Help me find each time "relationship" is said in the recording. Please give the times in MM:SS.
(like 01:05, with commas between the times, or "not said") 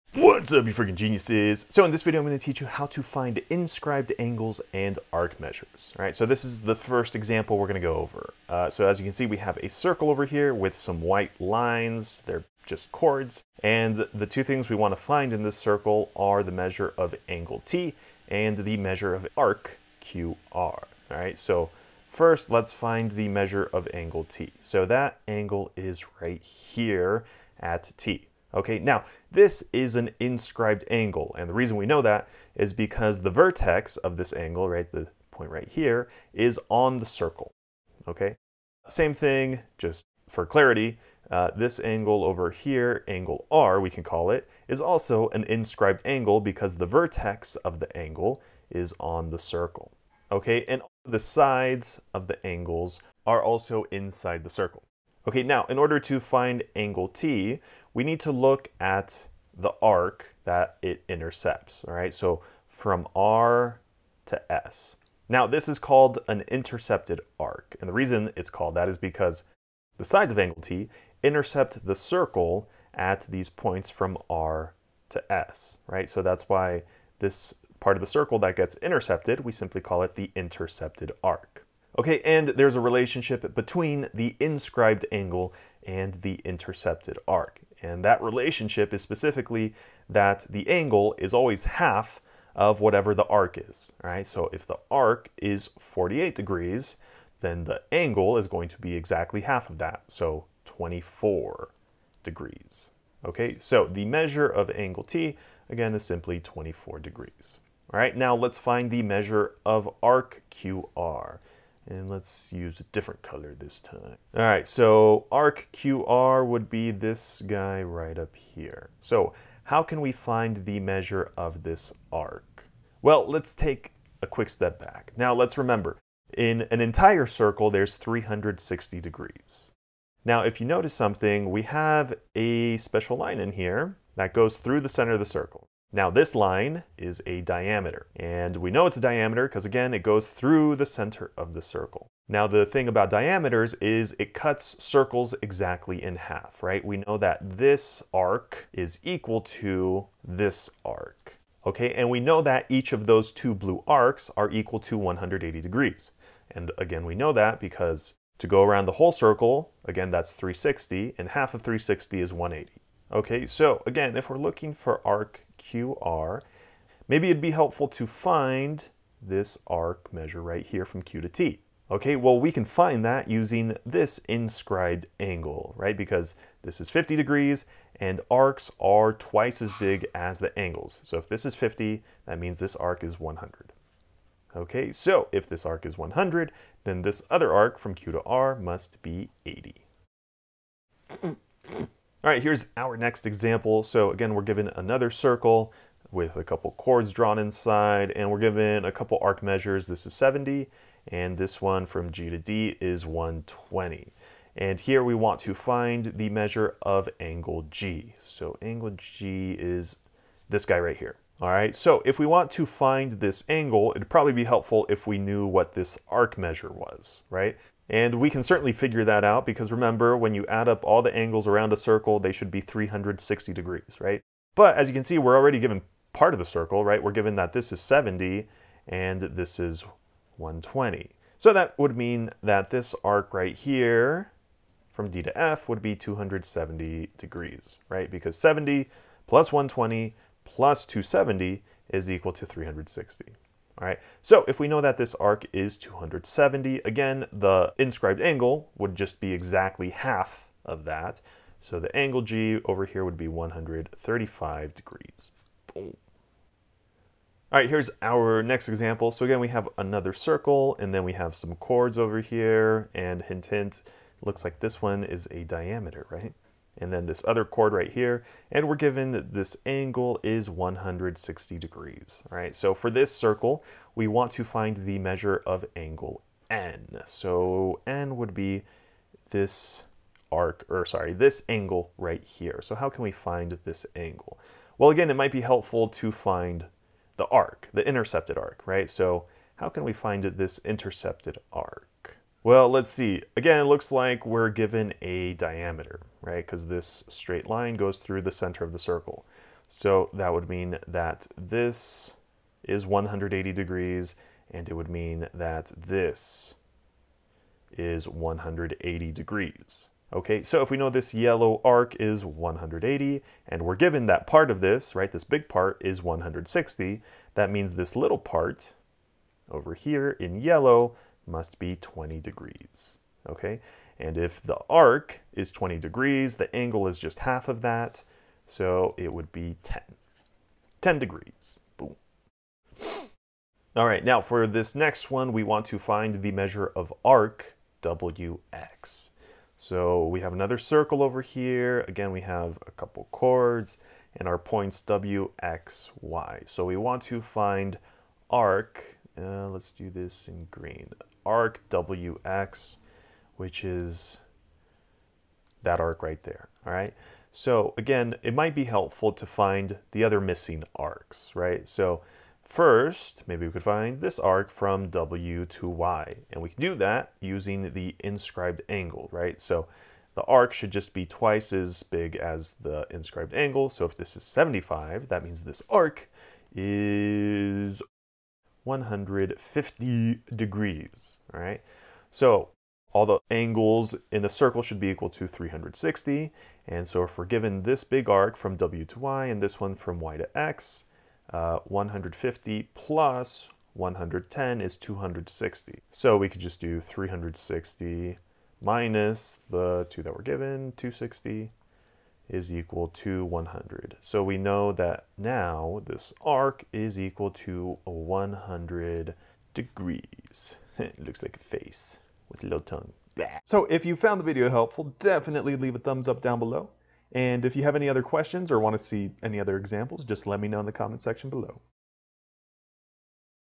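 01:22, 01:28.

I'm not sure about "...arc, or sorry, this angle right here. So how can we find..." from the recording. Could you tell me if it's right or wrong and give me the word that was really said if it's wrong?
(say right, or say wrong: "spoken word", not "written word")
right.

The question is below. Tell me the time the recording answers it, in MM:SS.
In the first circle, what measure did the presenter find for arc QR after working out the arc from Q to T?
03:09.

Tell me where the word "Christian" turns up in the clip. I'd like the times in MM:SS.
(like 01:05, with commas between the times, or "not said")
not said.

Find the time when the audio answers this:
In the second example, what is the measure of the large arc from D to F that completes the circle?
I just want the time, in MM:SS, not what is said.
03:55.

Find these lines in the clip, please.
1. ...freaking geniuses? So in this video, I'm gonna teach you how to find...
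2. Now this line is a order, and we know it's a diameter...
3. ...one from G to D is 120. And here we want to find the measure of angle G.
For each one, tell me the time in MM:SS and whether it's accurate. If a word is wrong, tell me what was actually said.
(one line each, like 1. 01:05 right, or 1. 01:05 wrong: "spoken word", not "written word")
1. 00:00 right
2. 02:15 wrong: "diameter", not "order"
3. 03:21 right.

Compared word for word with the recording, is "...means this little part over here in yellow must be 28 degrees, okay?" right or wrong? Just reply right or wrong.
wrong.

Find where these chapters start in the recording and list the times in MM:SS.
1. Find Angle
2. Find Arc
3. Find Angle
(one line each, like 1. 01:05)
1. 04:17
2. 05:32
3. 03:11.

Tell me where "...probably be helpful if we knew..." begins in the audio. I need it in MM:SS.
03:34.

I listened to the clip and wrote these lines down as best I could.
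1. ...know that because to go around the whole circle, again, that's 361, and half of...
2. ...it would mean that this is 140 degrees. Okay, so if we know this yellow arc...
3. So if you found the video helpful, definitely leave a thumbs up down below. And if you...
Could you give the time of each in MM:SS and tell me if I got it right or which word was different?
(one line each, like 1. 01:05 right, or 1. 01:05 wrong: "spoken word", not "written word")
1. 02:37 wrong: "360", not "361"
2. 05:04 wrong: "180", not "140"
3. 06:53 right.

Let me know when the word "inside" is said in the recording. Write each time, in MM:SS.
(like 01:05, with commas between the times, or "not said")
00:53, 03:17.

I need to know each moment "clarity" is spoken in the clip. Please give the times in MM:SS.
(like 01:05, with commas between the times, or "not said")
00:40.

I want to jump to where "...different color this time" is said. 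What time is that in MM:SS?
01:52.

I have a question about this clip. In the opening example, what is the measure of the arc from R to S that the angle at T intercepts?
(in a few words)
48 degrees.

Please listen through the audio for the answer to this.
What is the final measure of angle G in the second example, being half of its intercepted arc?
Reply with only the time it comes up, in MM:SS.
04:13.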